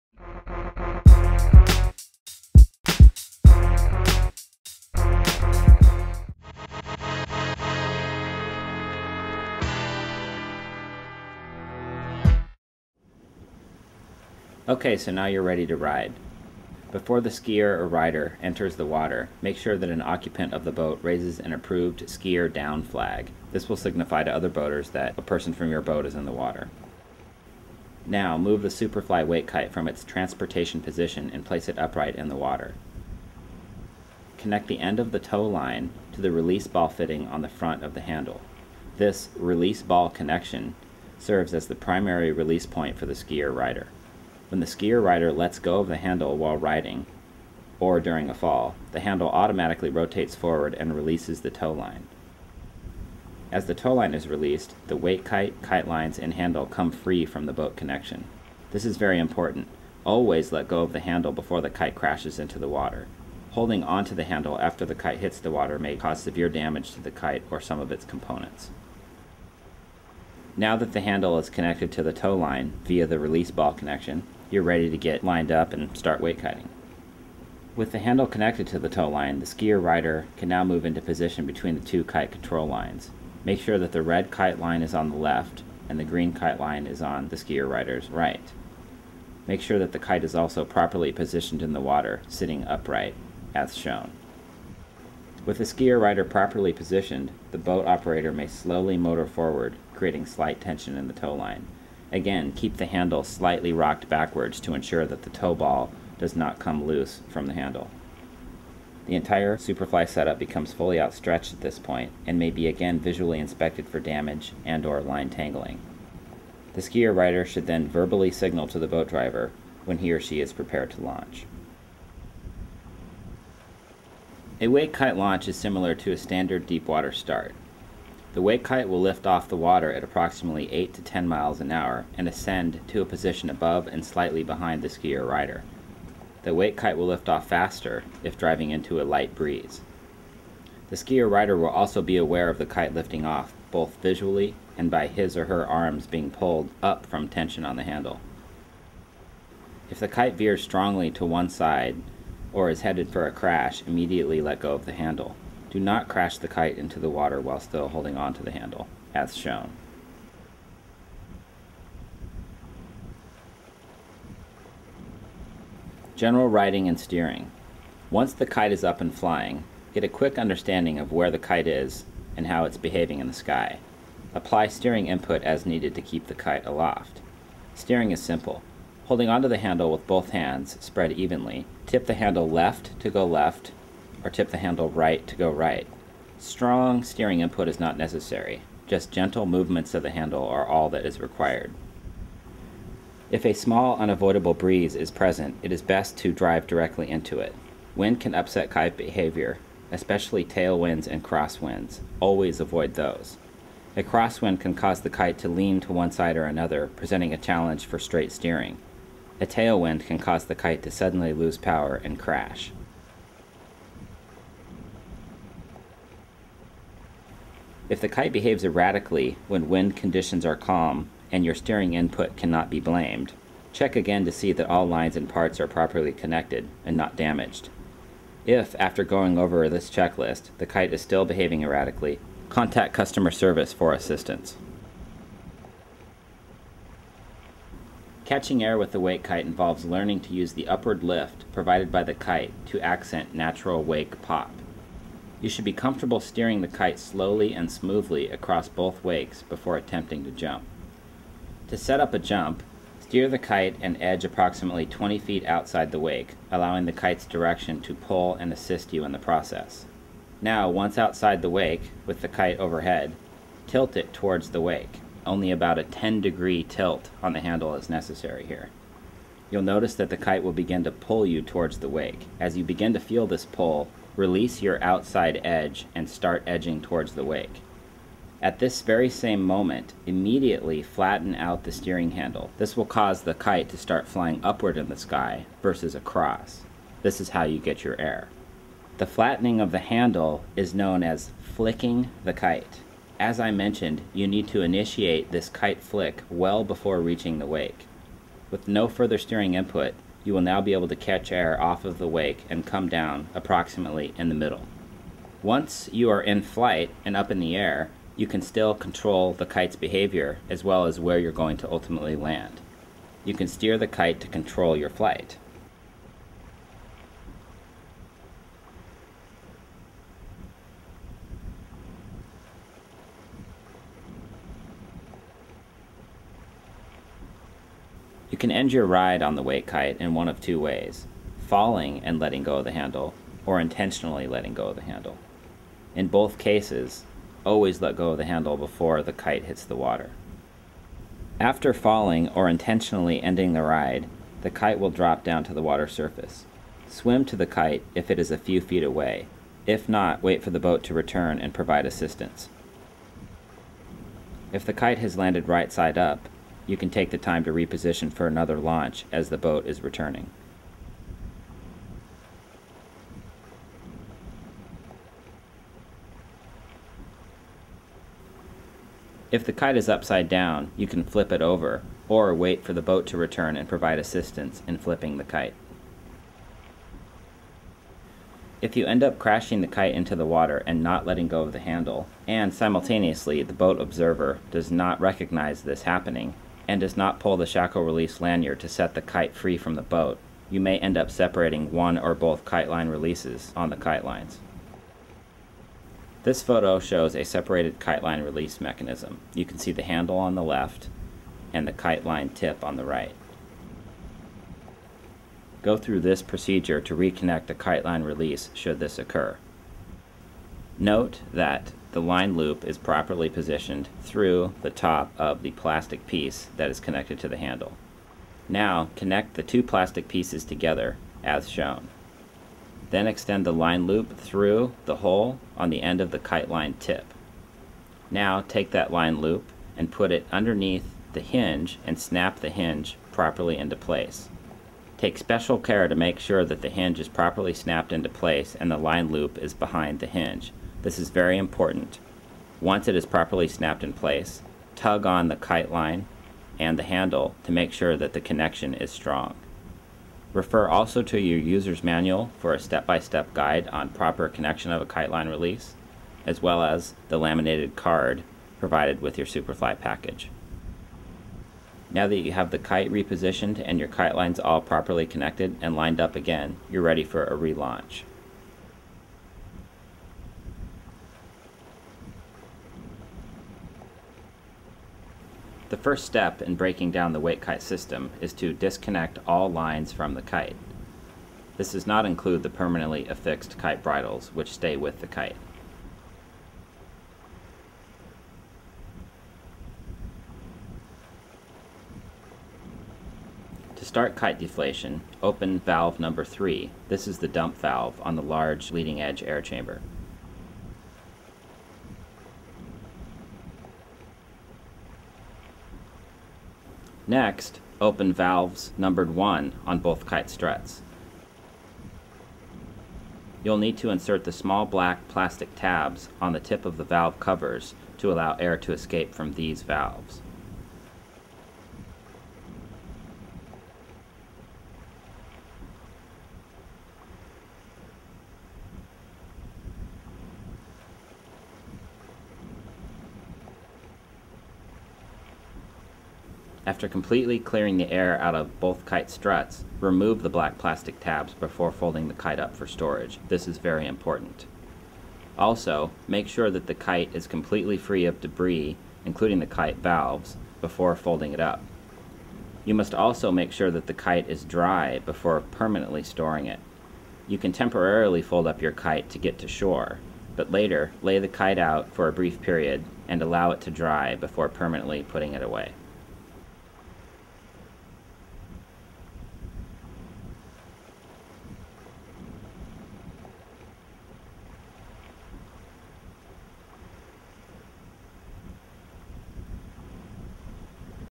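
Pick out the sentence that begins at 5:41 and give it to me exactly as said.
After falling or intentionally ending the ride, the kite will drop down to the water surface.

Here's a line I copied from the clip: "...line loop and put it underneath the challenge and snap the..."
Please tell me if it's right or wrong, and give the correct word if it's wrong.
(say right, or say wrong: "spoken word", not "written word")
wrong: "hinge", not "challenge".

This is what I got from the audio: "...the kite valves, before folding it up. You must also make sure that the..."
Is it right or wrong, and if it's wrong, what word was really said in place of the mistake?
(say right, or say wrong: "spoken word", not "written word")
right.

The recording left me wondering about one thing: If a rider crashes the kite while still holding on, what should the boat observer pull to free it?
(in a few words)
Shackle release lanyard.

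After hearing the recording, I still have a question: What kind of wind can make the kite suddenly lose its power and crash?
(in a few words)
Tailwind.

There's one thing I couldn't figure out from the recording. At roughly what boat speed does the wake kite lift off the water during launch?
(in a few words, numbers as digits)
8 to 10 miles an hour.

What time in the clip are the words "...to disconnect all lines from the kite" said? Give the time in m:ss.
7:58.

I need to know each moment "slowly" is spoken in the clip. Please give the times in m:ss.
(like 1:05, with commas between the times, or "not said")
1:38, 4:06.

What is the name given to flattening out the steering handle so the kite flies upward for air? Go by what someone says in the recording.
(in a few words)
Flicking the kite.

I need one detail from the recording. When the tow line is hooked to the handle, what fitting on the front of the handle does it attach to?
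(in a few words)
Release ball fitting.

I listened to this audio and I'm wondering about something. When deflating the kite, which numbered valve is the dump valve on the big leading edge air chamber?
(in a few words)
3.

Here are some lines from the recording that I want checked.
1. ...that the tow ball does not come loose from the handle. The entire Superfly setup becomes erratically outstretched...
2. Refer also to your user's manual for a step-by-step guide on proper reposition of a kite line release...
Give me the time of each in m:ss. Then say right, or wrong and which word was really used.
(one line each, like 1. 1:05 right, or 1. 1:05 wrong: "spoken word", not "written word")
1. 1:45 wrong: "fully", not "erratically"
2. 7:30 wrong: "connection", not "reposition".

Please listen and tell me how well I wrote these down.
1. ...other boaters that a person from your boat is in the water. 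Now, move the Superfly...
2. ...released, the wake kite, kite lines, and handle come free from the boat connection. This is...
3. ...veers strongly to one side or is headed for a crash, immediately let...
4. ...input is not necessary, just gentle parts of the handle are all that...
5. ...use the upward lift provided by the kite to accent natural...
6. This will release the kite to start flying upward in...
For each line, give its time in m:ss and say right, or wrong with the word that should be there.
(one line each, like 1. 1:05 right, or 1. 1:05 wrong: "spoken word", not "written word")
1. 0:24 right
2. 0:54 right
3. 2:30 right
4. 3:07 wrong: "movements", not "parts"
5. 4:00 right
6. 4:42 wrong: "cause", not "release".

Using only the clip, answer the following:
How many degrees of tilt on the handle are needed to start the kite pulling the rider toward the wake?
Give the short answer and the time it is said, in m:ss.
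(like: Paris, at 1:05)
10 degrees, at 4:25.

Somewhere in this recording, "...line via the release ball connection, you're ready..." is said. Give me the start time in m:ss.
1:12.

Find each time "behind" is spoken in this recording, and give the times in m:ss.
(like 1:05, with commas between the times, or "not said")
2:14, 7:19.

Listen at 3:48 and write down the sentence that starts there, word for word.
If, after going over this checklist, the kite is still behaving erratically, contact customer service for assistance.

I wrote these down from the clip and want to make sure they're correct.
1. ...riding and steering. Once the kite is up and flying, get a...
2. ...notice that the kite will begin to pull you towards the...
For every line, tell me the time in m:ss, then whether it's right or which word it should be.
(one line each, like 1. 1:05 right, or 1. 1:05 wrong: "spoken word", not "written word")
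1. 2:46 right
2. 4:29 right.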